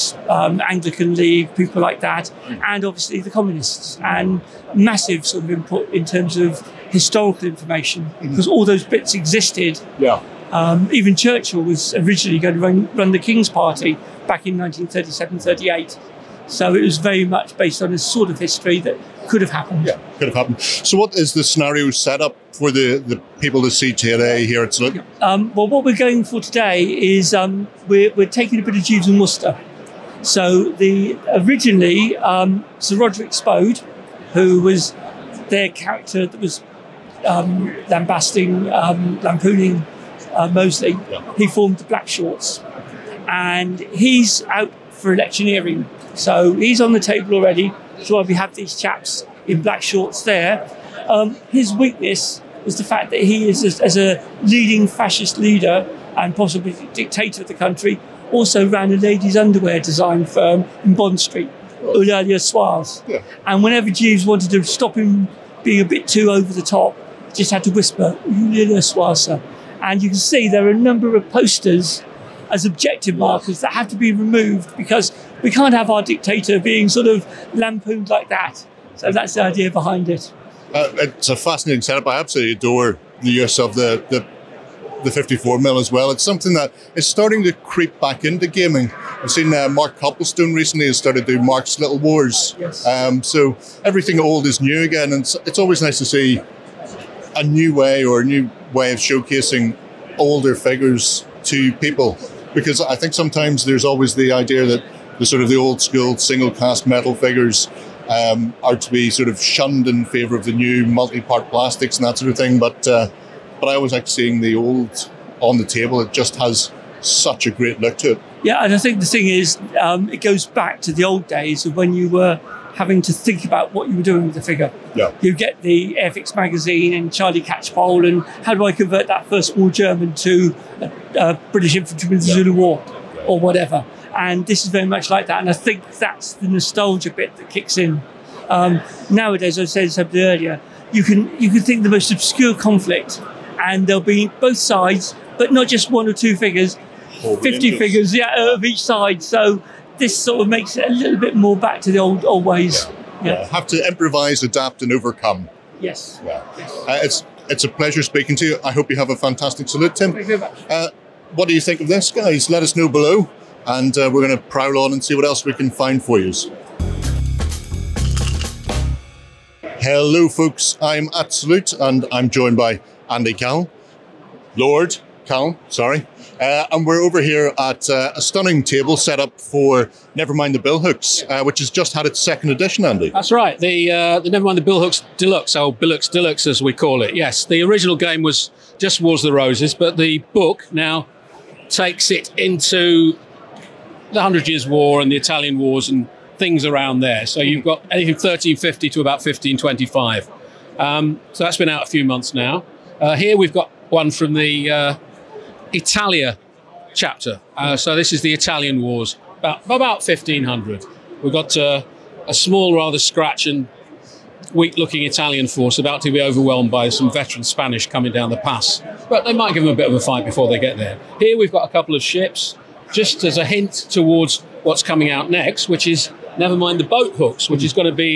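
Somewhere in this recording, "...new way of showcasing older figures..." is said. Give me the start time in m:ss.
1:38.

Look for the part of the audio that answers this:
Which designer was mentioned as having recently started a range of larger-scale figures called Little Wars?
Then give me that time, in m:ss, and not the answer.
1:29.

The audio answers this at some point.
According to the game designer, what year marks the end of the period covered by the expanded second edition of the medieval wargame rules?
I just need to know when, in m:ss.
3:19.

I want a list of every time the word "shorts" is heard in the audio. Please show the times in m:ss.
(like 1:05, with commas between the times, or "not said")
0:42, 0:49.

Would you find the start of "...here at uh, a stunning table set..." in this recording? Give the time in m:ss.
2:57.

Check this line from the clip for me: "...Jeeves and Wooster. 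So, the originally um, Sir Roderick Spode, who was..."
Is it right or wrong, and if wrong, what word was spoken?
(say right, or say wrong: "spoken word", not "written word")
right.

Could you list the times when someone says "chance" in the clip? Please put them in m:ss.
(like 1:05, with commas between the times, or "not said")
not said.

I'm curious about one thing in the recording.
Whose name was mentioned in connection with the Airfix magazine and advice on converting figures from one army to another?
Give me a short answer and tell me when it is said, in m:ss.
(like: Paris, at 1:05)
Charlie Catchpole, at 2:07.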